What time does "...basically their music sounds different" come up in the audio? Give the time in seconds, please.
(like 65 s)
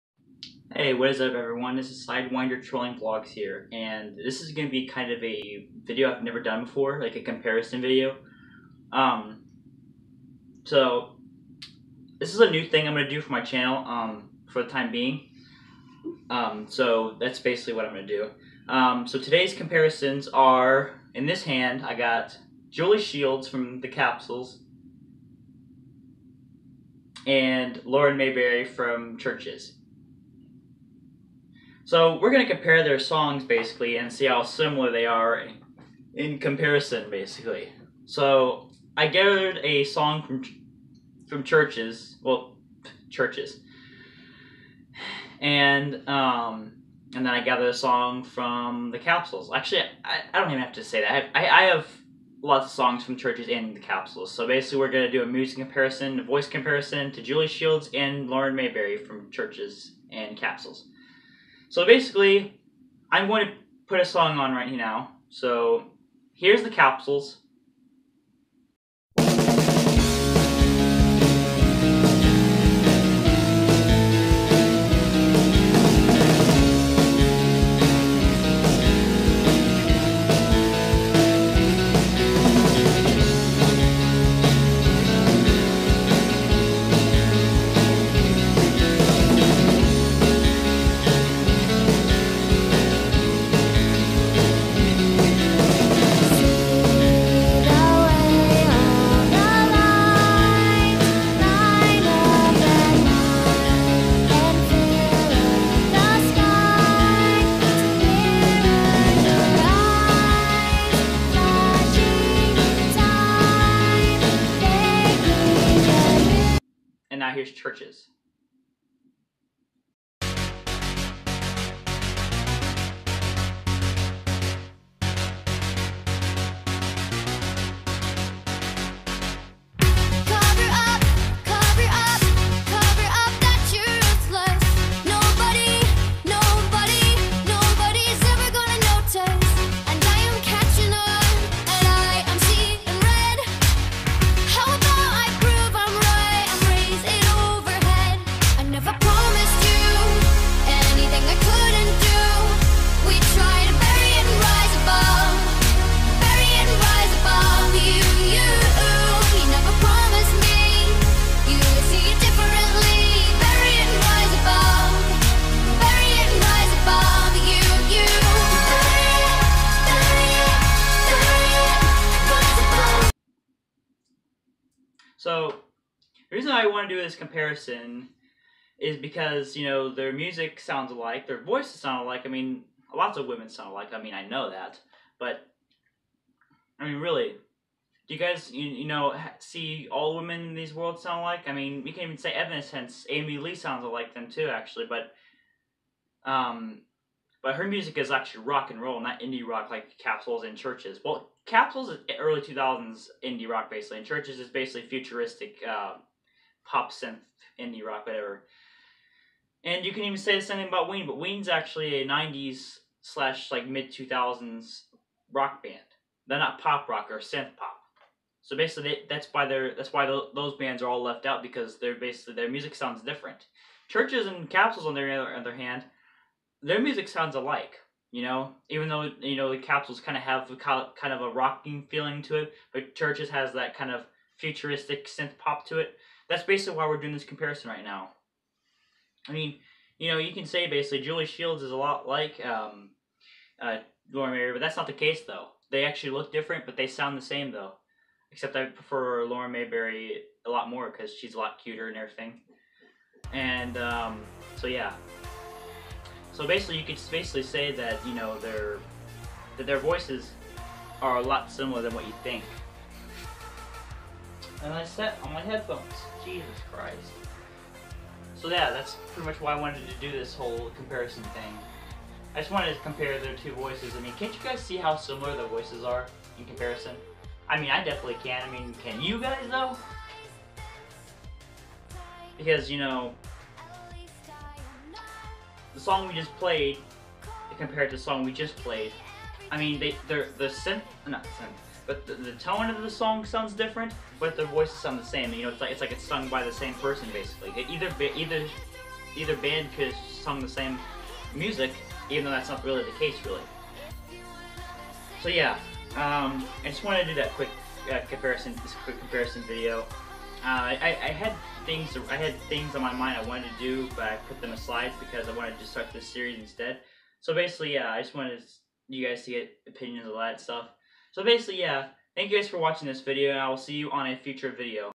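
221 s.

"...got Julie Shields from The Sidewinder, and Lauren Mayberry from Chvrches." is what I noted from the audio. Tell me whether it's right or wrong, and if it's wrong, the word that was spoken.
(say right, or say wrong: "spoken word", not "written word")
wrong: "Capsules", not "Sidewinder".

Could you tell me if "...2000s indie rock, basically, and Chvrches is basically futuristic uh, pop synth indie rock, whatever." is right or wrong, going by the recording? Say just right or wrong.
right.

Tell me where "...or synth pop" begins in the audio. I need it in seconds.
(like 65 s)
217 s.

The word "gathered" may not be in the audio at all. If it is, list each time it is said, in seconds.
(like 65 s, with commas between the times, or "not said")
39 s, 47 s.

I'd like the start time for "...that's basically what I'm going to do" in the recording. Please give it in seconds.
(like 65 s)
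17 s.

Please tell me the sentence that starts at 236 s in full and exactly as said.
That's basically why we're doing this comparison right now.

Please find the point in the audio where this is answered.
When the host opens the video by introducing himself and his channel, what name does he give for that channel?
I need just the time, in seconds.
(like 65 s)
2 s.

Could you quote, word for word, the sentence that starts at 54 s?
So basically, we're gonna do a music comparison, a voice comparison to Julie Shields and Lauren Mayberry from Chvrches and capsules.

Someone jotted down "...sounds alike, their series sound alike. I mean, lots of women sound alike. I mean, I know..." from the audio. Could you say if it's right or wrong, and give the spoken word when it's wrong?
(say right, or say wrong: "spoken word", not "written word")
wrong: "voices", not "series".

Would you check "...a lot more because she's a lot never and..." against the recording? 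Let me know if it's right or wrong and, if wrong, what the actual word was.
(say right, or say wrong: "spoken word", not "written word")
wrong: "cuter", not "never".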